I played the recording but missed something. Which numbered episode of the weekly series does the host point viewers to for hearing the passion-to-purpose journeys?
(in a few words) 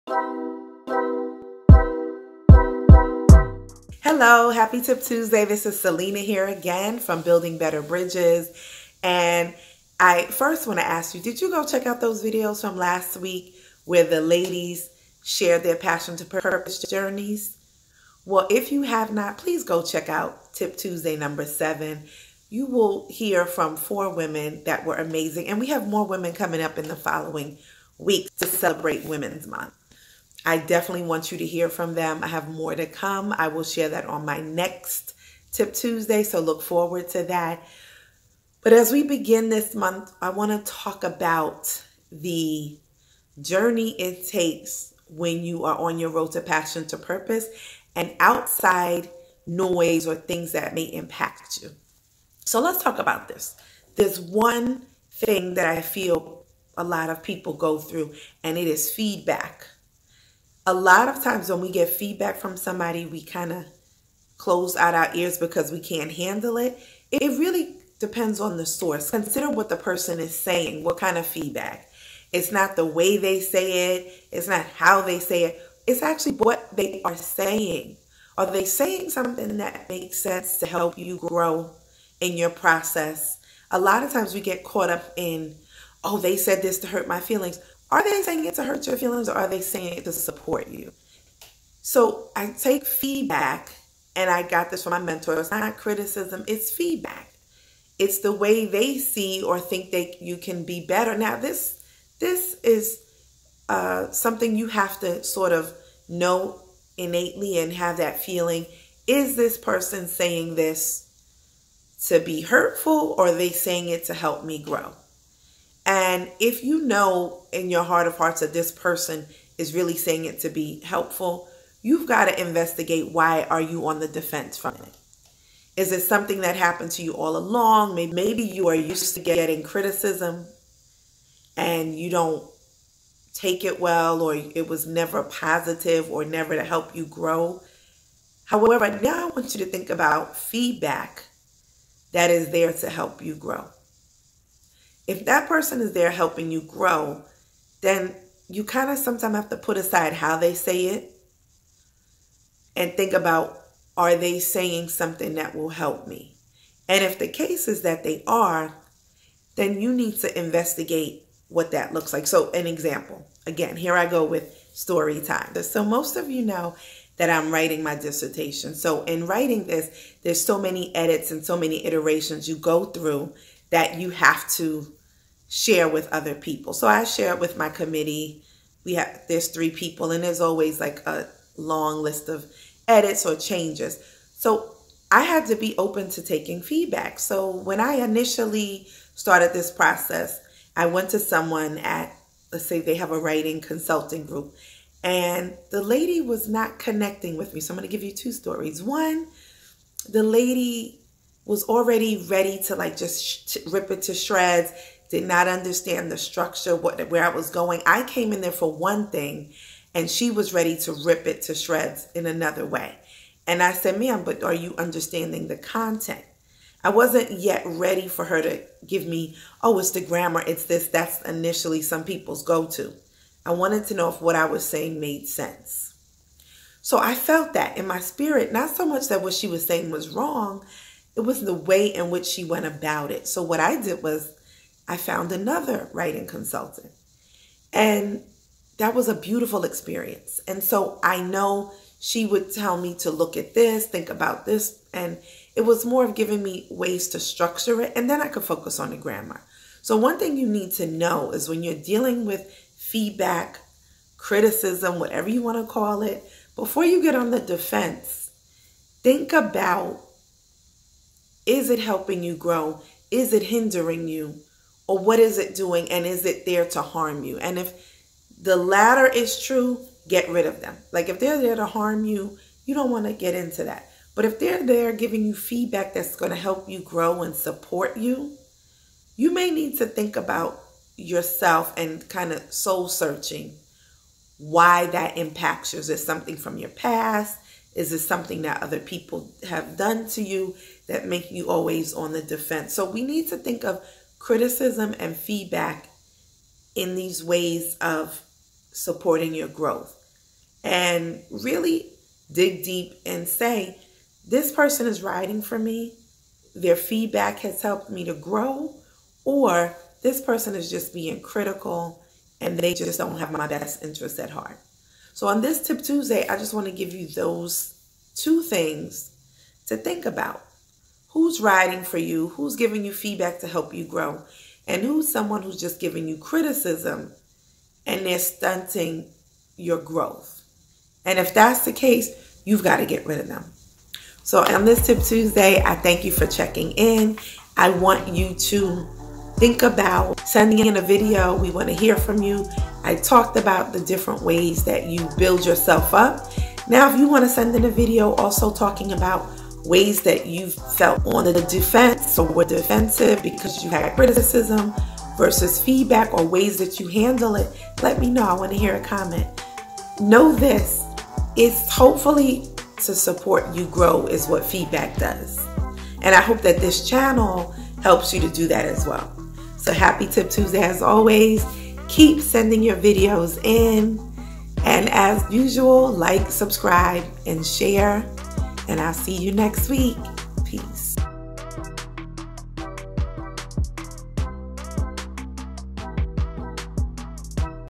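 7.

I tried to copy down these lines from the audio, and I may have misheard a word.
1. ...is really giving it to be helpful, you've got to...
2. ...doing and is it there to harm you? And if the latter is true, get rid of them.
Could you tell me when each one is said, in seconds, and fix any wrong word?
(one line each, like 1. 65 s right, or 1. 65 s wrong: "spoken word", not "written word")
1. 119 s wrong: "saying", not "giving"
2. 265 s right.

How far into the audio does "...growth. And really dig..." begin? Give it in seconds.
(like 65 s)
299 s.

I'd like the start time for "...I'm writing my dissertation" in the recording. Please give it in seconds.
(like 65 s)
167 s.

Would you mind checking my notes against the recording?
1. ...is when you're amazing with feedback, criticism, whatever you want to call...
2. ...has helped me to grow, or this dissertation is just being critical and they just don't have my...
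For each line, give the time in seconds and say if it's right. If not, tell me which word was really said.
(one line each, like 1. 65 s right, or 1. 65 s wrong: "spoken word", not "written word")
1. 251 s wrong: "dealing", not "amazing"
2. 307 s wrong: "person", not "dissertation".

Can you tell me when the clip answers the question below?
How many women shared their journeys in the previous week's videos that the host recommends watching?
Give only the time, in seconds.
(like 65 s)
23 s.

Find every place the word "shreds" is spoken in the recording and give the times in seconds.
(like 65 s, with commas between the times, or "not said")
204 s, 211 s.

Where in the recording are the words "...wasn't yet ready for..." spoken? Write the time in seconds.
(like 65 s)
216 s.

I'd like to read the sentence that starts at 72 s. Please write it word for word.
It's not the way they say it, it's not how they say it, it's actually what they are saying.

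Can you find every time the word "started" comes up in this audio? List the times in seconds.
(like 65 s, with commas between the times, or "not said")
189 s.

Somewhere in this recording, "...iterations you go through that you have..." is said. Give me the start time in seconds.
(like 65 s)
171 s.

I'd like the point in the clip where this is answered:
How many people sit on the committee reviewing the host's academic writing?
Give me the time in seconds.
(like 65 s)
179 s.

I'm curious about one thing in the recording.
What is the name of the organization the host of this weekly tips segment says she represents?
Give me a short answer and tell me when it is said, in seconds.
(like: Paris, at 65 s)
Building Better Bridges, at 7 s.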